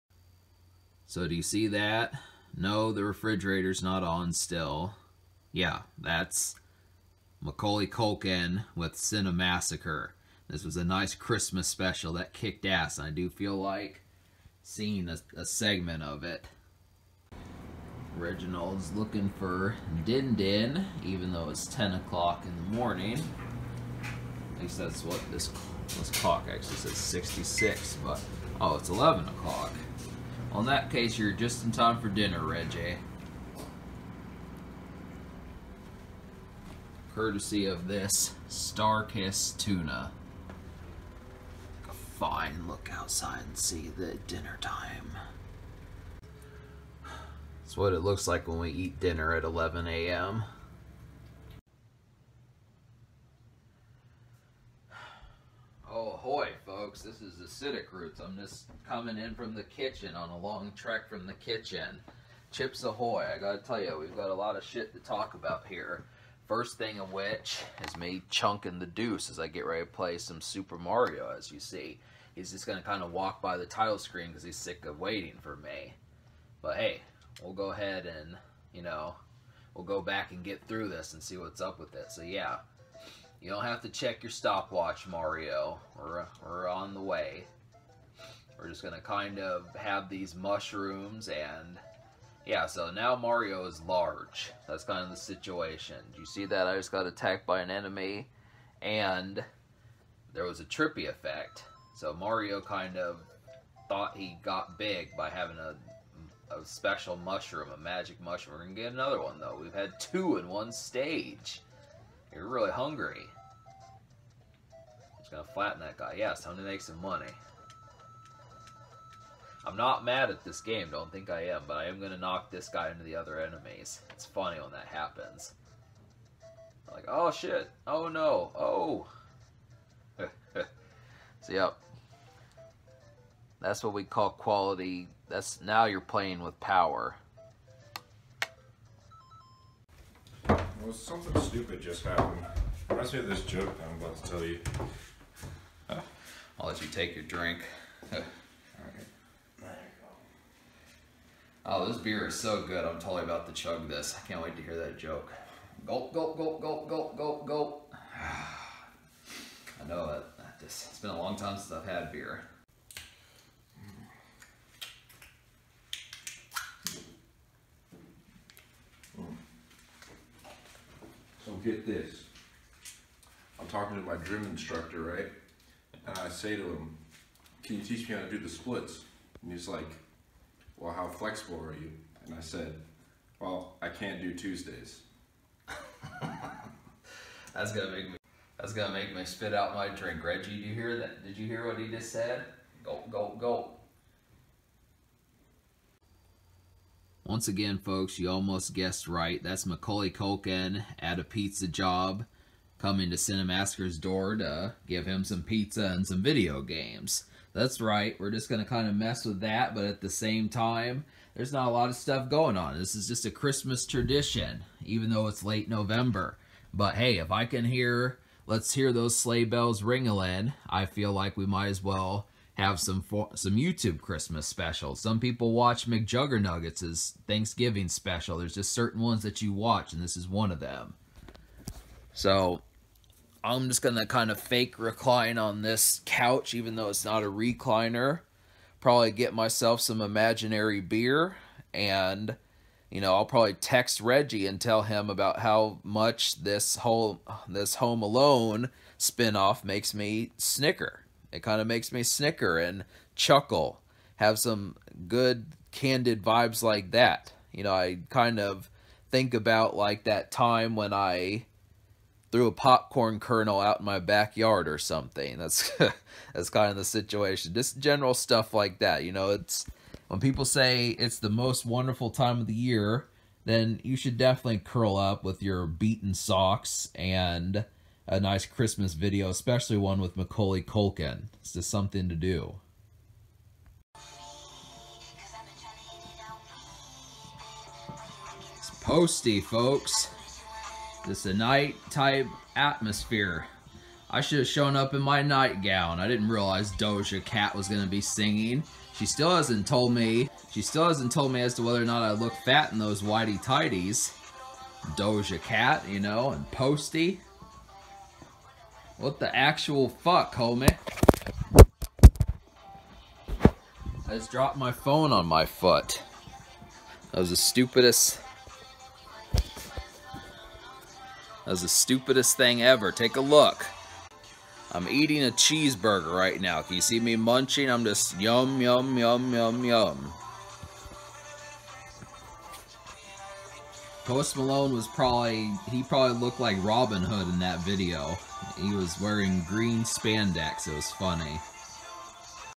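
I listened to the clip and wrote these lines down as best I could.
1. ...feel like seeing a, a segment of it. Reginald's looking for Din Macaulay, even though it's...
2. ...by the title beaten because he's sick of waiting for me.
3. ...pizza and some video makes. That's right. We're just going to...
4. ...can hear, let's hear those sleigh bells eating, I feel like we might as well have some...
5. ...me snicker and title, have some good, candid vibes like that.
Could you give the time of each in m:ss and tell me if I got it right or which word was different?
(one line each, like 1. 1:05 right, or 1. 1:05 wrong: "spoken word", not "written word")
1. 0:13 wrong: "Din", not "Macaulay"
2. 1:13 wrong: "screen", not "beaten"
3. 3:25 wrong: "games", not "makes"
4. 3:37 wrong: "ringling", not "eating"
5. 4:11 wrong: "chuckle", not "title".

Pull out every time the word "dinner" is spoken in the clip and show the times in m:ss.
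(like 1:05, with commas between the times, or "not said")
0:32, 0:44, 0:48.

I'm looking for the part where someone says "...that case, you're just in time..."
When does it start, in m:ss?
0:30.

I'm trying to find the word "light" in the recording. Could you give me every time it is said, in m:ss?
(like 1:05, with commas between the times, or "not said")
not said.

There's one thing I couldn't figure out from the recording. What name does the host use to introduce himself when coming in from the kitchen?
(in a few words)
Acidic Roots.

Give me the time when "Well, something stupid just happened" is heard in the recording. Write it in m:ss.
2:20.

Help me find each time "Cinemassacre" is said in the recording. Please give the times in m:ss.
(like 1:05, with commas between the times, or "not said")
0:08, 3:23.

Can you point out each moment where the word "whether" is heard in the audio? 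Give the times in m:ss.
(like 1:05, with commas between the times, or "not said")
5:01.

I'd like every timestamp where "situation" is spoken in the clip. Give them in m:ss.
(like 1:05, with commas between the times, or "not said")
1:35, 4:26.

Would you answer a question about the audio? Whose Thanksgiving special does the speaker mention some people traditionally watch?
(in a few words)
McJuggernuggets.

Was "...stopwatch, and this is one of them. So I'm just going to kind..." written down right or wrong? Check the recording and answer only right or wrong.
wrong.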